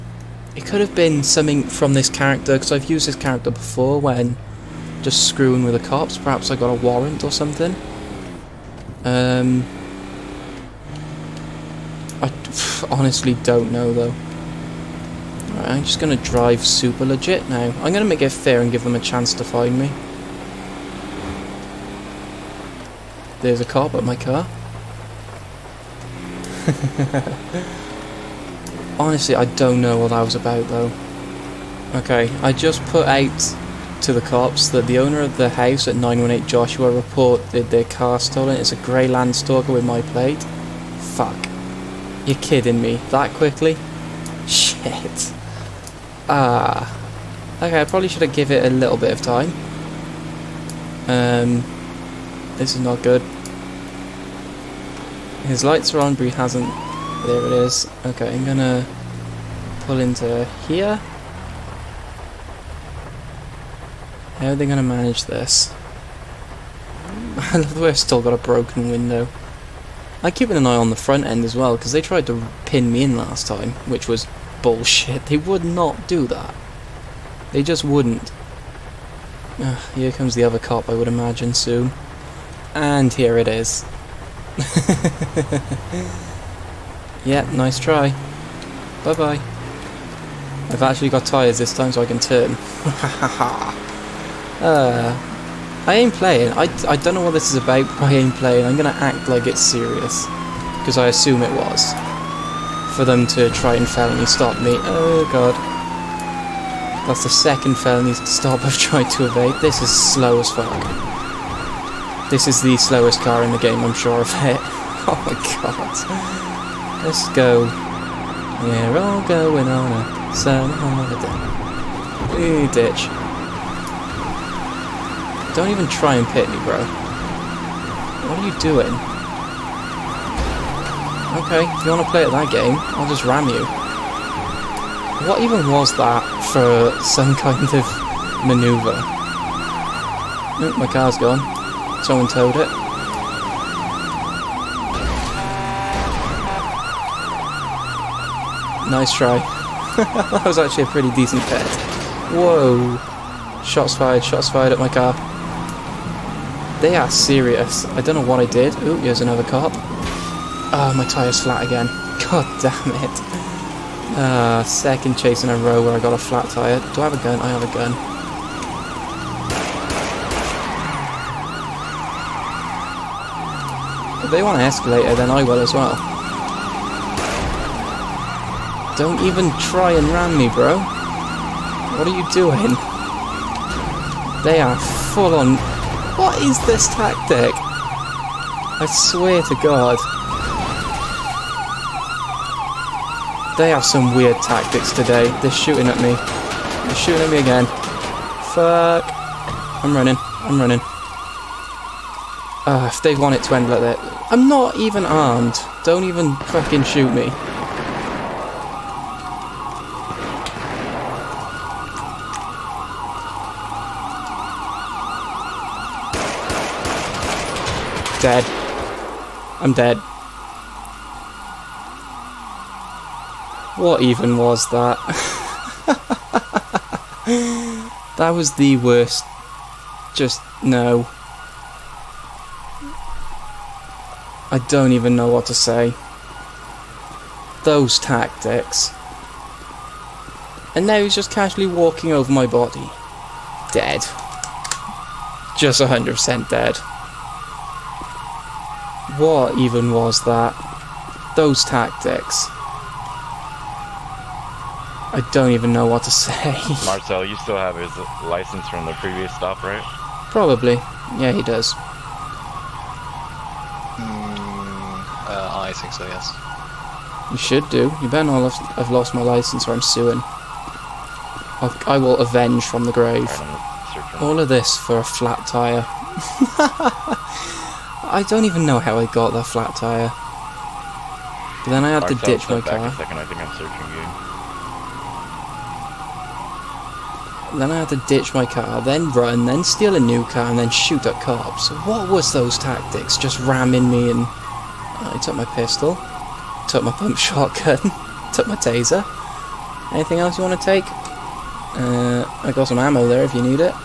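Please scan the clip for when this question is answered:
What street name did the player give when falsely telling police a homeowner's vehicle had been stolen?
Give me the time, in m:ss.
0:35.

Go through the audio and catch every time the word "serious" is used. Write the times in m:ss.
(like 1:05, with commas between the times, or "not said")
1:39, 2:37.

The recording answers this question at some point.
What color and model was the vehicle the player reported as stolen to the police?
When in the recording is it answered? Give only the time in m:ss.
0:38.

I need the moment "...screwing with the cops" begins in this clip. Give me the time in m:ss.
0:05.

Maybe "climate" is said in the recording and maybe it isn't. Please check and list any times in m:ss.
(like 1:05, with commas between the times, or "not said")
not said.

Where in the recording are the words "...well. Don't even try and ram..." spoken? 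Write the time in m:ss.
2:55.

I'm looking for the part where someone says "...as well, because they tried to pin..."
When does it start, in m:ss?
1:11.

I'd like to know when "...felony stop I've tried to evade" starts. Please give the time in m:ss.
1:47.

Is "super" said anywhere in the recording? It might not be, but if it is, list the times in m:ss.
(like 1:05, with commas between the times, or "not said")
0:16.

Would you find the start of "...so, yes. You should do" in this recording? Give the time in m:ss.
4:25.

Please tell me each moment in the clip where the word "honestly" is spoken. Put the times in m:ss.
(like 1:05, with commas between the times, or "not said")
0:12, 0:28.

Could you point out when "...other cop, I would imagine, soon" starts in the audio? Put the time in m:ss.
1:20.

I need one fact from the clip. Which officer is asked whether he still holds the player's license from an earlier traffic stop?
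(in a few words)
Marcel.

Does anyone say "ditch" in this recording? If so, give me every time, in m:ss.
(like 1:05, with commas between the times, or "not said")
2:02, 4:42, 4:48.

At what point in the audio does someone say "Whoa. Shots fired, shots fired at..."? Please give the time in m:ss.
2:32.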